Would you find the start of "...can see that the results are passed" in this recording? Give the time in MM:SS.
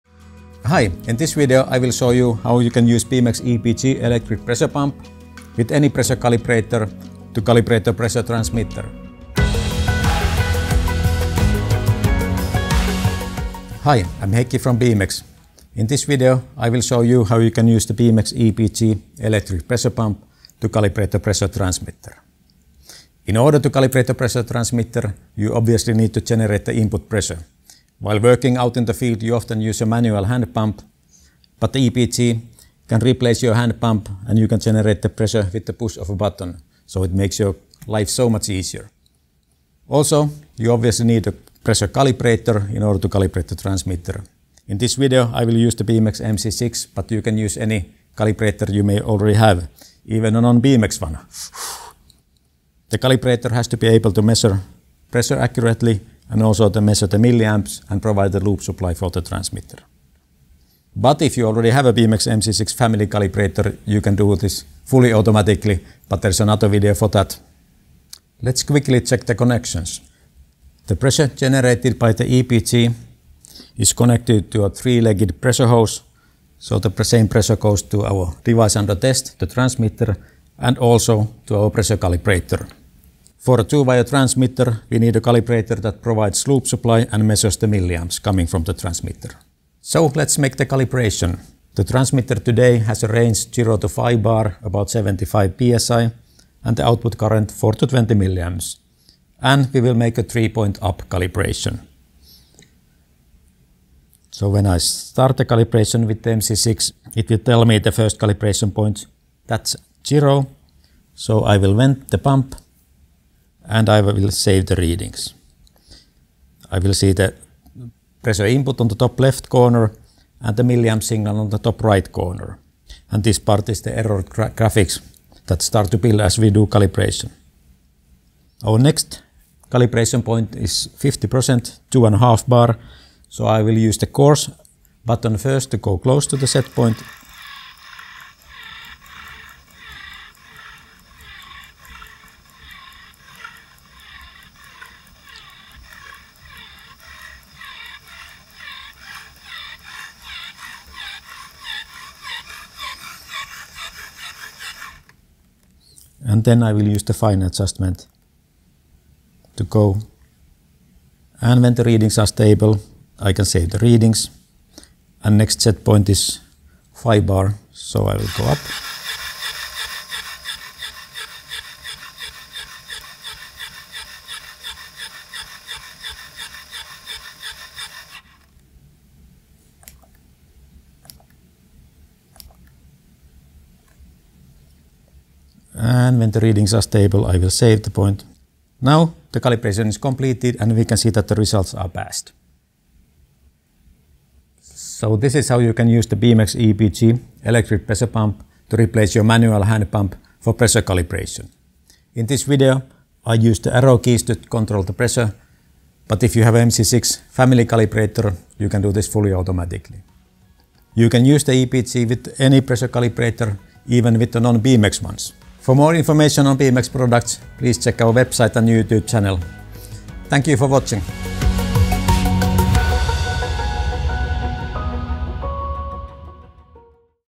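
03:10.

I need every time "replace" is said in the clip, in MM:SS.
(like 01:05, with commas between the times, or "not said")
00:33, 03:18.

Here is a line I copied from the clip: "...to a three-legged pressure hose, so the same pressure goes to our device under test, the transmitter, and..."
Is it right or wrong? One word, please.
right.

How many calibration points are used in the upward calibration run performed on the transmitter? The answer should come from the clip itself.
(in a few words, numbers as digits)
3.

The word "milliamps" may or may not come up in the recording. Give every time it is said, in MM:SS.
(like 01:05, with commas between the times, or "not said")
00:57, 01:27, 01:38, 02:00.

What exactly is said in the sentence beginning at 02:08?
Our next calibration point is 50%, 2.5 bar.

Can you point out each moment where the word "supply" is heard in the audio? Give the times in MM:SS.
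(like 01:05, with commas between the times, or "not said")
00:58, 01:26.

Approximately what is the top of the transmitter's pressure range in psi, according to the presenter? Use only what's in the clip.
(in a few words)
75 psi.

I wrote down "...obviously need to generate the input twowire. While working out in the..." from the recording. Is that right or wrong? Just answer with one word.
wrong.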